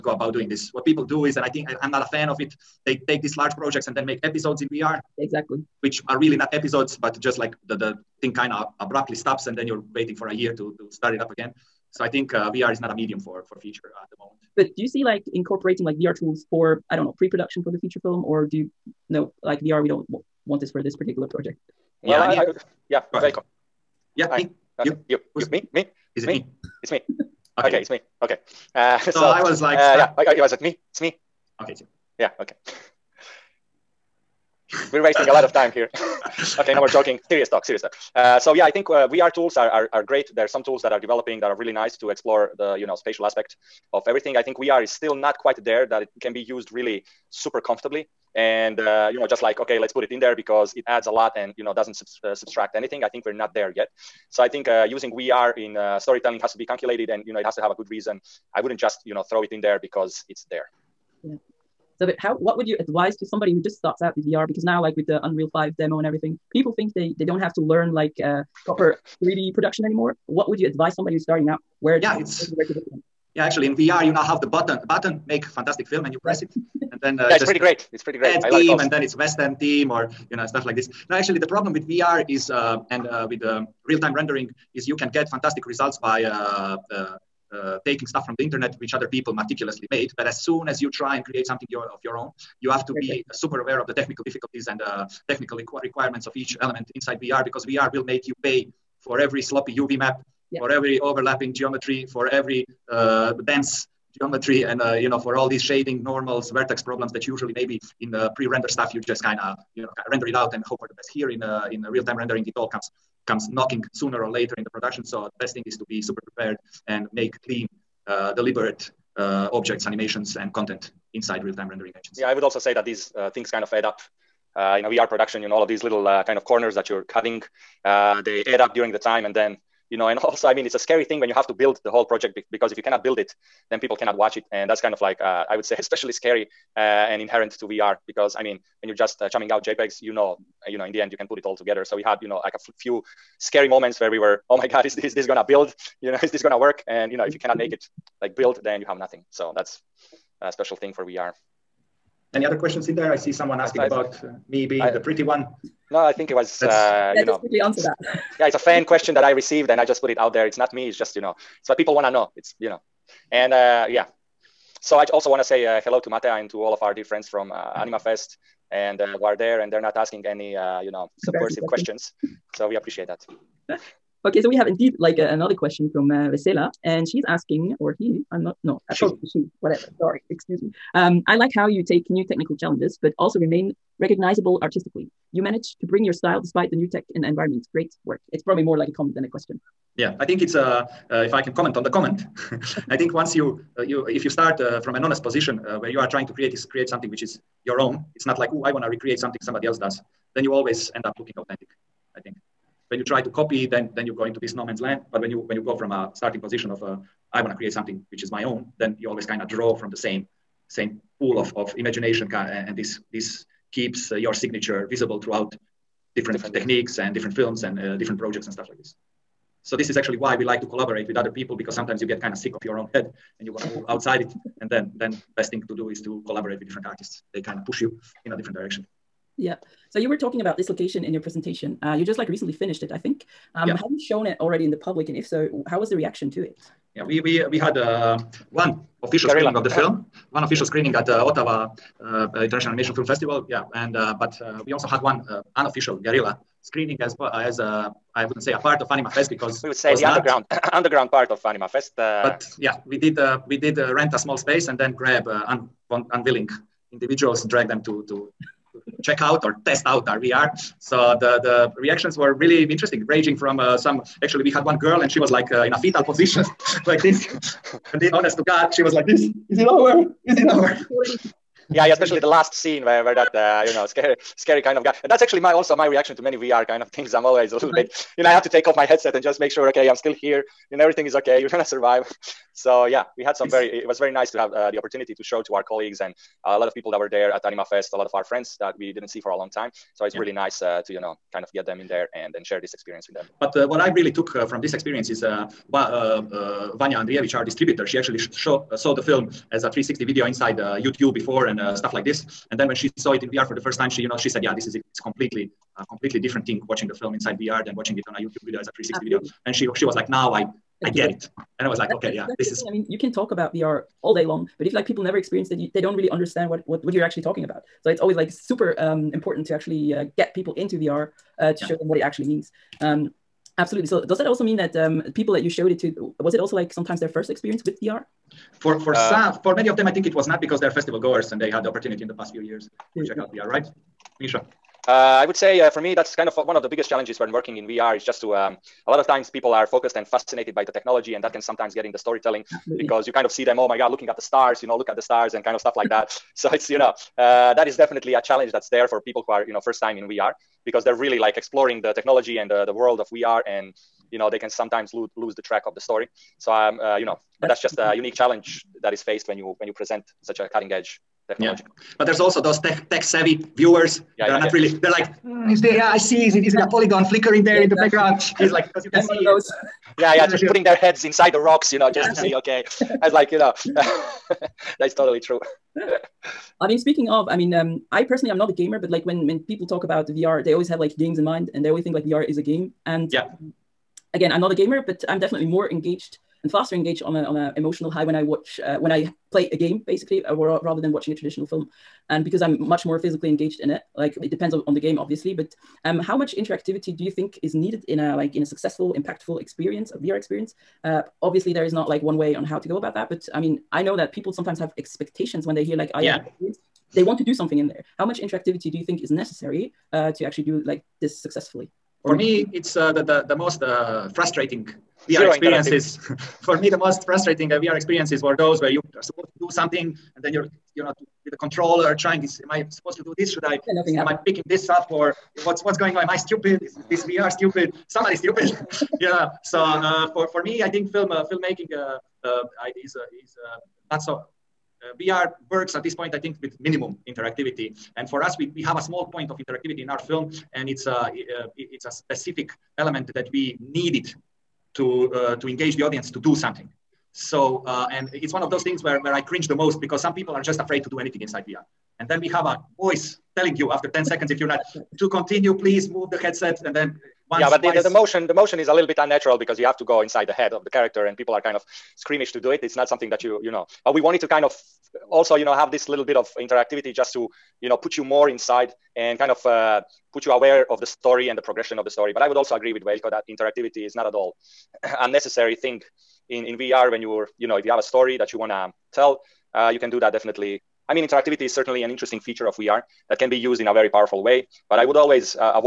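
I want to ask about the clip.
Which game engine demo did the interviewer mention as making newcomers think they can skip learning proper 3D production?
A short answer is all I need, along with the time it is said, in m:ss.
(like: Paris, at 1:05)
Unreal 5, at 1:05.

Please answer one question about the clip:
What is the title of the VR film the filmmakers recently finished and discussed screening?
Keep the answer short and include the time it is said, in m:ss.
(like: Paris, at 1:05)
Dislocation, at 3:50.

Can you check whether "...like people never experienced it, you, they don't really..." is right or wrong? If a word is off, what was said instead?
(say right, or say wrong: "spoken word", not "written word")
right.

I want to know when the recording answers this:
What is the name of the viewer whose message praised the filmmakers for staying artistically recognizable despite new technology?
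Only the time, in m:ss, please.
2:56.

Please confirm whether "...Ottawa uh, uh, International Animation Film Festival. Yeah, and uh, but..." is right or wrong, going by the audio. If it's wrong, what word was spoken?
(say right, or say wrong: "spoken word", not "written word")
right.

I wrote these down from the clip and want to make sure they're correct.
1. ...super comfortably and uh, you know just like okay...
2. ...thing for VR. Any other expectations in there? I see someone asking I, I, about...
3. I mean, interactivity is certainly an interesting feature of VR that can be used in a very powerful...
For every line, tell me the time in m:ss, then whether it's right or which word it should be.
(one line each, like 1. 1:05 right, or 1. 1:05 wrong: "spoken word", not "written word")
1. 0:47 right
2. 2:30 wrong: "questions", not "expectations"
3. 8:00 right.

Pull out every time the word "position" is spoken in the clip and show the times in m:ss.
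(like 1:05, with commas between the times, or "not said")
3:15, 3:26, 4:26.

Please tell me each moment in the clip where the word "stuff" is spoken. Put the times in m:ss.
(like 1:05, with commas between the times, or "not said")
1:20, 1:28, 1:48, 3:38, 5:01, 5:45.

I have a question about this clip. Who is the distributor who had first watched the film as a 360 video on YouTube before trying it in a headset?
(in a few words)
Vanja Andrijević.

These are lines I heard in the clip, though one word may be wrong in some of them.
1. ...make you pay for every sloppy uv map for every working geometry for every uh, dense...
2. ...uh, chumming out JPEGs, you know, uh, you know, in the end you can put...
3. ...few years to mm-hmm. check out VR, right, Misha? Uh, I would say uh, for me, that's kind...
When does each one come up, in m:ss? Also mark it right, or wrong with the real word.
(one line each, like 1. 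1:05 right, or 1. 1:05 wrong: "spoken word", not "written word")
1. 1:38 wrong: "overlapping", not "working"
2. 2:19 right
3. 5:32 right.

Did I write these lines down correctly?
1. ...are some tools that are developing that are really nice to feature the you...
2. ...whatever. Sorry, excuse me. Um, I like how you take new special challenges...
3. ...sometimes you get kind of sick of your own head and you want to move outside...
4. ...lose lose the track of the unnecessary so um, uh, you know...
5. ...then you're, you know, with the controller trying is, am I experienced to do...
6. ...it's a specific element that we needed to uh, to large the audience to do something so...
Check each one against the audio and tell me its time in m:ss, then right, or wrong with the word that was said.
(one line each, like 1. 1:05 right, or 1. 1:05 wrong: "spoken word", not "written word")
1. 0:40 wrong: "explore", not "feature"
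2. 2:59 wrong: "technical", not "special"
3. 3:41 right
4. 5:54 wrong: "story", not "unnecessary"
5. 7:00 wrong: "supposed", not "experienced"
6. 7:21 wrong: "engage", not "large".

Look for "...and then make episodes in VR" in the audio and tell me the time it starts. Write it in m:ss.
0:03.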